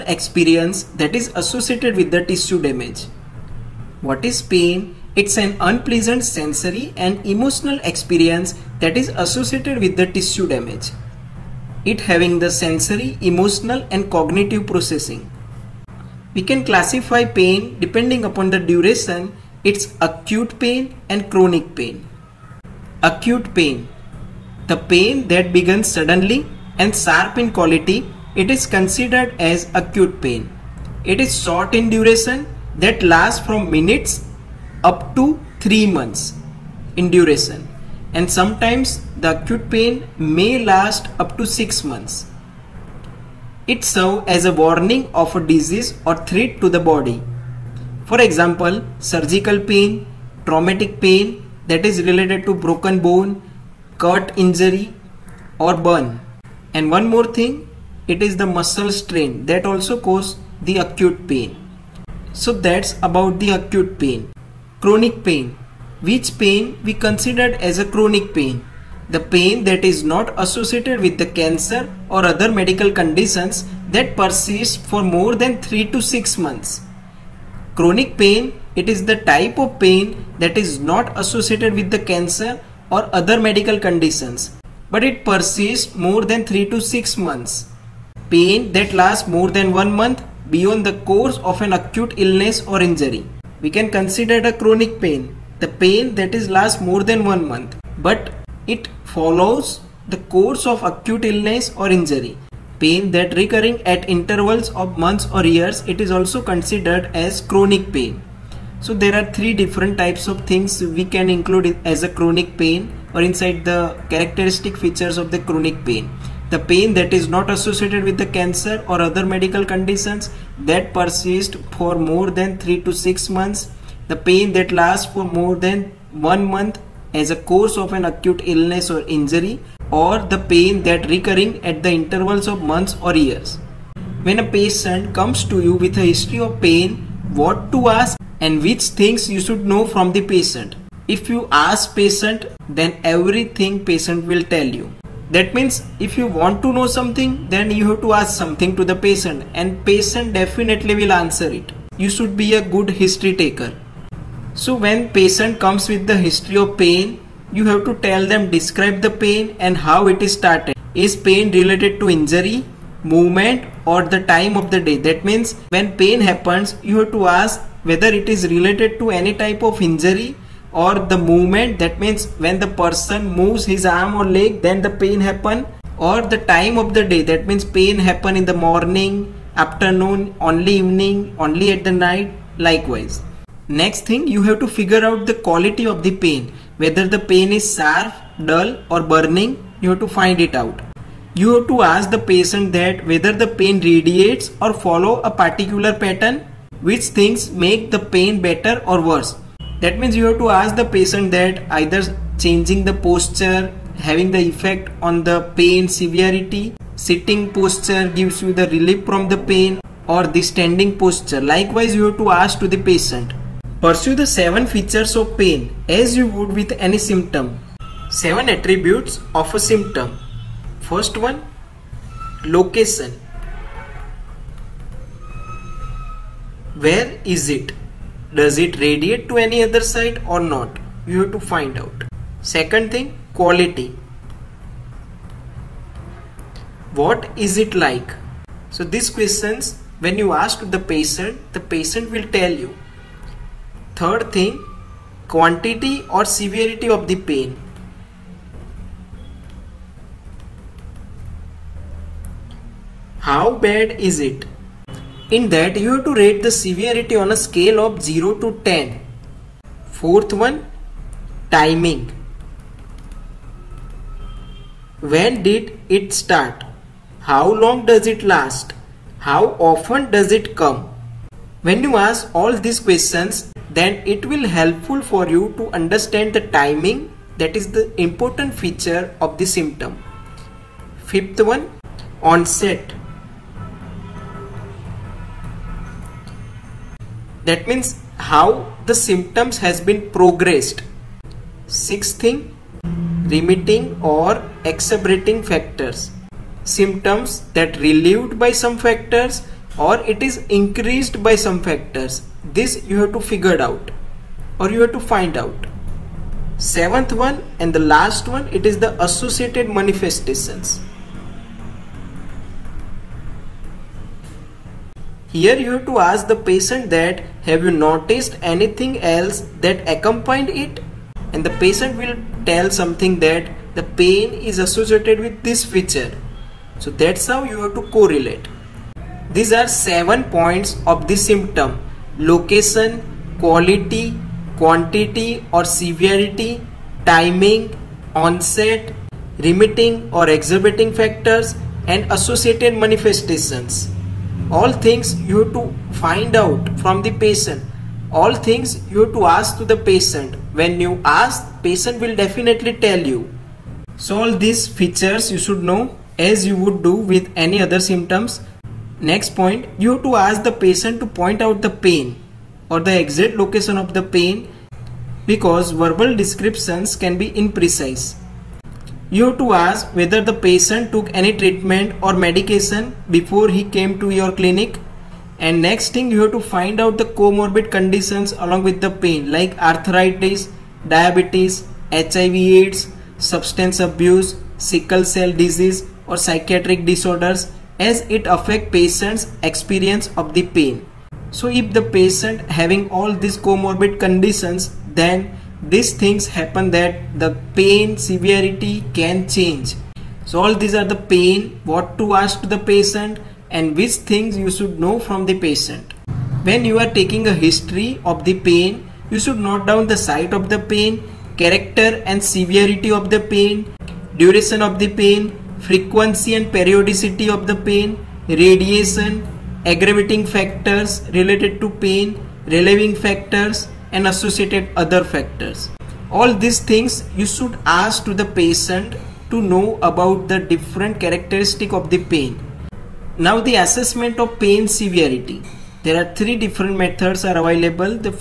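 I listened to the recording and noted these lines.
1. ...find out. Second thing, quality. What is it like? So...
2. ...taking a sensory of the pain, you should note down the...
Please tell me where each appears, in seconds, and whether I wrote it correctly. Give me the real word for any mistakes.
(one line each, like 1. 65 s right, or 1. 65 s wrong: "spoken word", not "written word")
1. 231 s right
2. 406 s wrong: "history", not "sensory".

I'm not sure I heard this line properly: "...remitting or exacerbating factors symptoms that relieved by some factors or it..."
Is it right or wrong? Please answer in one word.
right.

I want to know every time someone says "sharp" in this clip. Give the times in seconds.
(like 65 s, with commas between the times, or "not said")
26 s, 187 s.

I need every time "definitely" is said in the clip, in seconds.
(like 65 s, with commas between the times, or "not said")
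150 s, 352 s.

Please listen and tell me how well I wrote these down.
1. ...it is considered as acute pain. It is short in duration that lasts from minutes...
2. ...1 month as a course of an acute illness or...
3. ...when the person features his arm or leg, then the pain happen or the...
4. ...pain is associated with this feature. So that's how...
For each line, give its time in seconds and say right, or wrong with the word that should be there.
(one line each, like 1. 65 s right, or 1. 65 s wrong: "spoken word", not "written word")
1. 28 s right
2. 126 s right
3. 172 s wrong: "moves", not "features"
4. 323 s right.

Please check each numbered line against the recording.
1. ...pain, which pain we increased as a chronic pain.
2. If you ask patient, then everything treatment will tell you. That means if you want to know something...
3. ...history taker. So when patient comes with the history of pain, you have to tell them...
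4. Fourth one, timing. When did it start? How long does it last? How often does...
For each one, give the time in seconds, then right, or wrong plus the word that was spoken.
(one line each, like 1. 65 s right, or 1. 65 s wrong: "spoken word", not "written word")
1. 65 s wrong: "considered", not "increased"
2. 141 s wrong: "patient", not "treatment"
3. 152 s right
4. 259 s right.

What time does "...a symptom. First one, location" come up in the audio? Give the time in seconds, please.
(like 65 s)
219 s.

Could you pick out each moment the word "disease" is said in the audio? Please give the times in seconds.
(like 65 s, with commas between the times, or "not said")
45 s, 385 s.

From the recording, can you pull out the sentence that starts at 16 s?
We can classify pain depending upon the duration it's acute pain and chronic pain.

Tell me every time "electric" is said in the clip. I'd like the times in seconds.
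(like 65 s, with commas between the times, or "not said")
not said.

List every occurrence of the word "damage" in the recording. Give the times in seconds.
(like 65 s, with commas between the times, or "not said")
2 s, 10 s.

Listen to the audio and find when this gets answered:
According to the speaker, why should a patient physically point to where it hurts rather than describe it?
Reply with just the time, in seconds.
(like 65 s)
367 s.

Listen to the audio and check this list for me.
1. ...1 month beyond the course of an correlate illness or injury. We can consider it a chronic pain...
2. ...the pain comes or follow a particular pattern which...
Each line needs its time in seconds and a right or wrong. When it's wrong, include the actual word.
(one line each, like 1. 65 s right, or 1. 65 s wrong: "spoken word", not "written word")
1. 89 s wrong: "acute", not "correlate"
2. 193 s wrong: "radiates", not "comes".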